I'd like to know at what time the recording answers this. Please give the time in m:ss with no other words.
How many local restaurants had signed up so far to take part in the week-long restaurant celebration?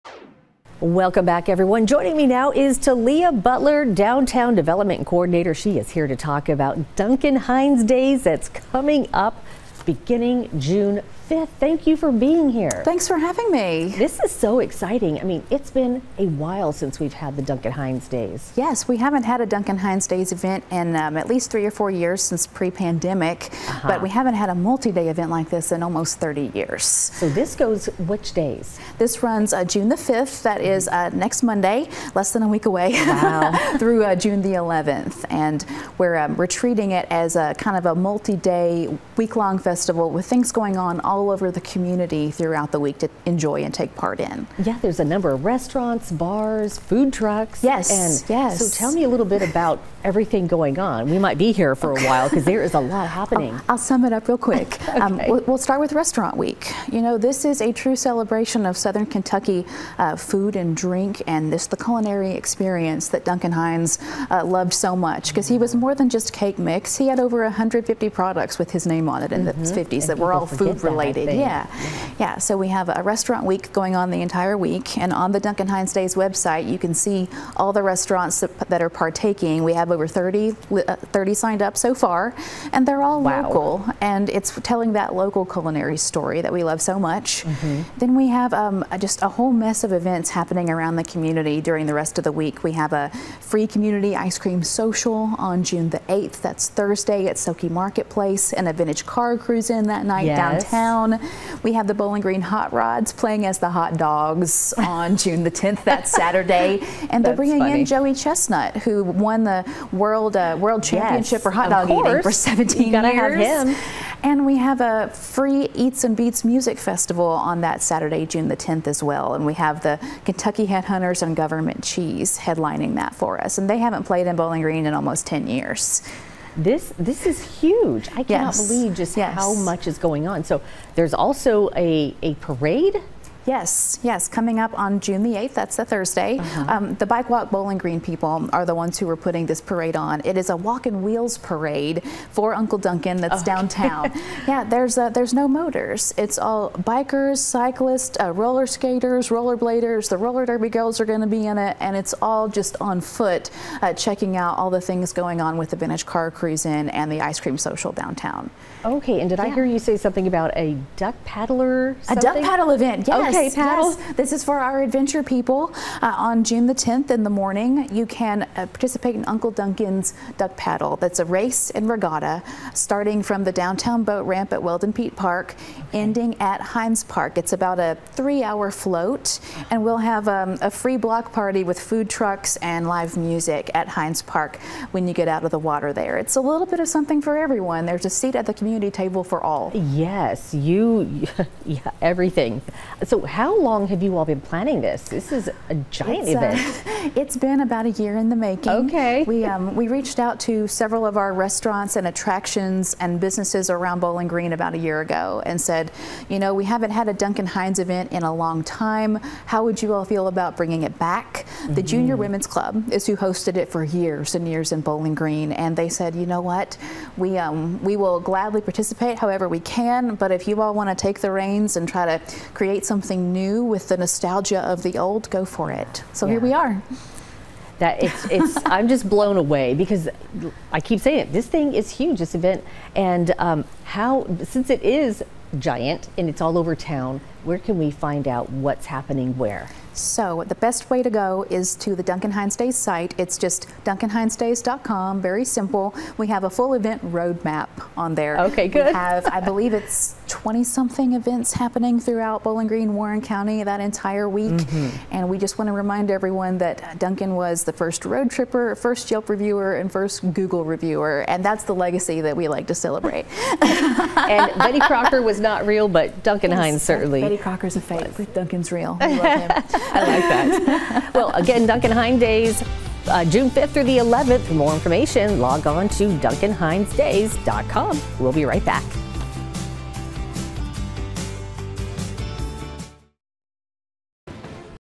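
1:21.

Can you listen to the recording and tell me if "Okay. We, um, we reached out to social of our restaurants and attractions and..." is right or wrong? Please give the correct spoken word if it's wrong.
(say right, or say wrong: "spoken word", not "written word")
wrong: "several", not "social".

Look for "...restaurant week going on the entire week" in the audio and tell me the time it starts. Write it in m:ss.
1:13.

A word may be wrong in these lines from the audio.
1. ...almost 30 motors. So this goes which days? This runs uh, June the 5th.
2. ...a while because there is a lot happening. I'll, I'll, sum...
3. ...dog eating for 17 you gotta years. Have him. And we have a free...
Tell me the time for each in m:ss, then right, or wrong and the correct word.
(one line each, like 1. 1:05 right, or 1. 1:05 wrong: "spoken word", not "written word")
1. 0:25 wrong: "years", not "motors"
2. 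0:51 right
3. 1:51 right.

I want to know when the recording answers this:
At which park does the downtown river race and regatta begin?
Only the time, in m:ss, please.
2:54.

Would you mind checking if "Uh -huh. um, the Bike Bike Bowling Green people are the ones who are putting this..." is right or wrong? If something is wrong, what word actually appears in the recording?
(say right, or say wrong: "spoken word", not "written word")
wrong: "Walk", not "Bike".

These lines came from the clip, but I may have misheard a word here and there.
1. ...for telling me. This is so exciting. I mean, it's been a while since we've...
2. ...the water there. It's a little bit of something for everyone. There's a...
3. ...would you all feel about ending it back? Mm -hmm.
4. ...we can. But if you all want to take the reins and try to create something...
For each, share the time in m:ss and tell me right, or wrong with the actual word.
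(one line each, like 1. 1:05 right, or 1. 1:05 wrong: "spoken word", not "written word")
1. 0:13 wrong: "having", not "telling"
2. 3:05 right
3. 3:29 wrong: "bringing", not "ending"
4. 3:39 right.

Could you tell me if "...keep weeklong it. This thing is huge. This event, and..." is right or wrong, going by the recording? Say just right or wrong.
wrong.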